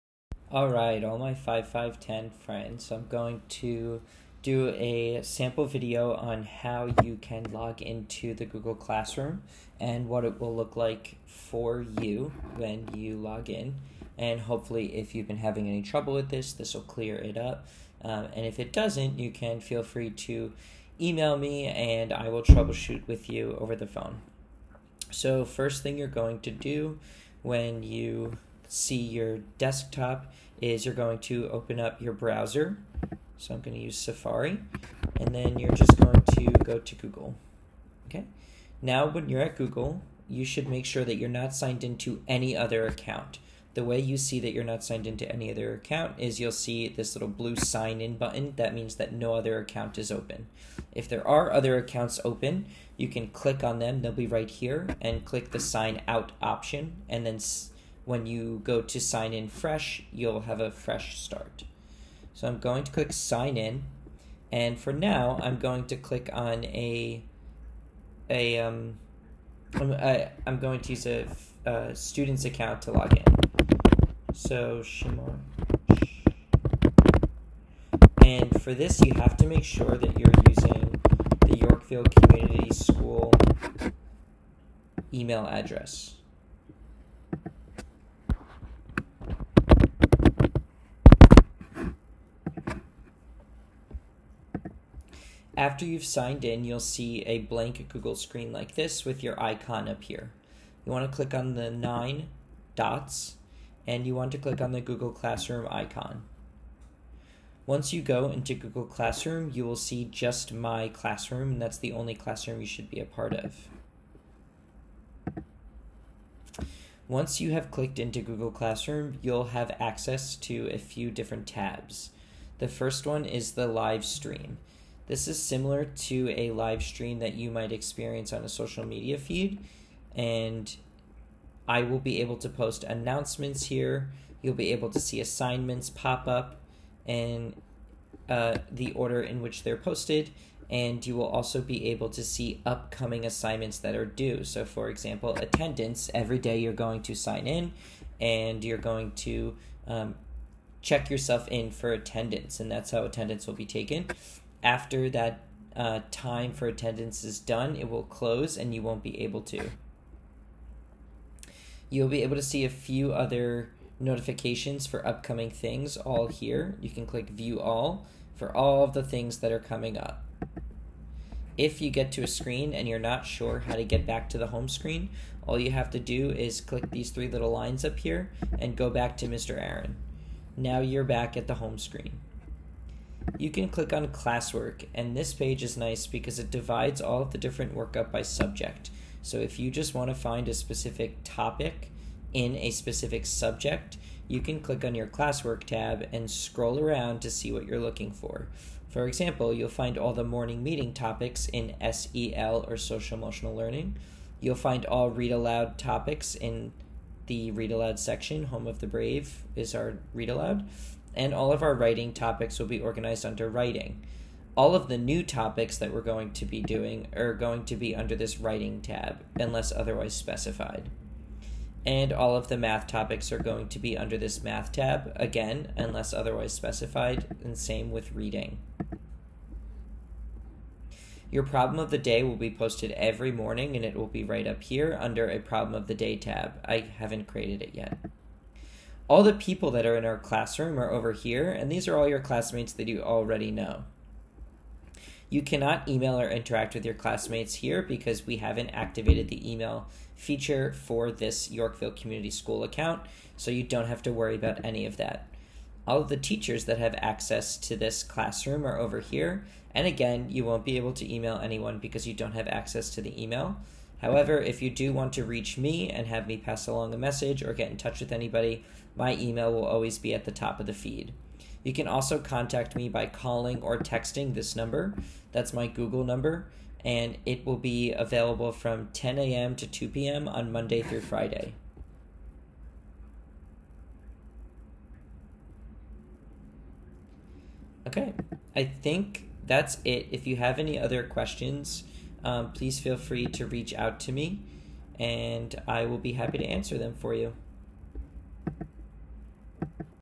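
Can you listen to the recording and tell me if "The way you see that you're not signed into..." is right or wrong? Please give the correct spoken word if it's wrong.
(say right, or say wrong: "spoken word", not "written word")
right.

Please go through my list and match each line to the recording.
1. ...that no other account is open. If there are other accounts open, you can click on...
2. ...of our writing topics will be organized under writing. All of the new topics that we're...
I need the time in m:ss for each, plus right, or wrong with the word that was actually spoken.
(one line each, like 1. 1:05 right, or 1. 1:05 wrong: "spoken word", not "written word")
1. 0:48 right
2. 3:31 right.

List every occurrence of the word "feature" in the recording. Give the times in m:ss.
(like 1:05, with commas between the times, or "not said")
4:10.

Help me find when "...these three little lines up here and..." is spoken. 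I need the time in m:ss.
2:56.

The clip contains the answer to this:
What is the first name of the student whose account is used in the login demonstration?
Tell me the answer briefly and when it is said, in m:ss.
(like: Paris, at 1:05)
Shimon, at 1:14.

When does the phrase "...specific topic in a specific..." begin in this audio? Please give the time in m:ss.
3:10.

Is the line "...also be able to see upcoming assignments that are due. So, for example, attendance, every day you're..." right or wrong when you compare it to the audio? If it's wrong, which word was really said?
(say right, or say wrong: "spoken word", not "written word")
right.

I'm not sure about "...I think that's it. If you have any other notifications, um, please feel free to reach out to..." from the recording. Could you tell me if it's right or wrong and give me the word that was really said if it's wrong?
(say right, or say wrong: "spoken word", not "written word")
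wrong: "questions", not "notifications".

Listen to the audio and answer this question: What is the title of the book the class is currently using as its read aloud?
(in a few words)
Home of the Brave.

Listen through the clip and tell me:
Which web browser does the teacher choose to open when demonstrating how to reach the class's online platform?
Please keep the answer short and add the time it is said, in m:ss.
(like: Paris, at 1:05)
Safari, at 0:33.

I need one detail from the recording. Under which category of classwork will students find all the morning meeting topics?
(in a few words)
SEL.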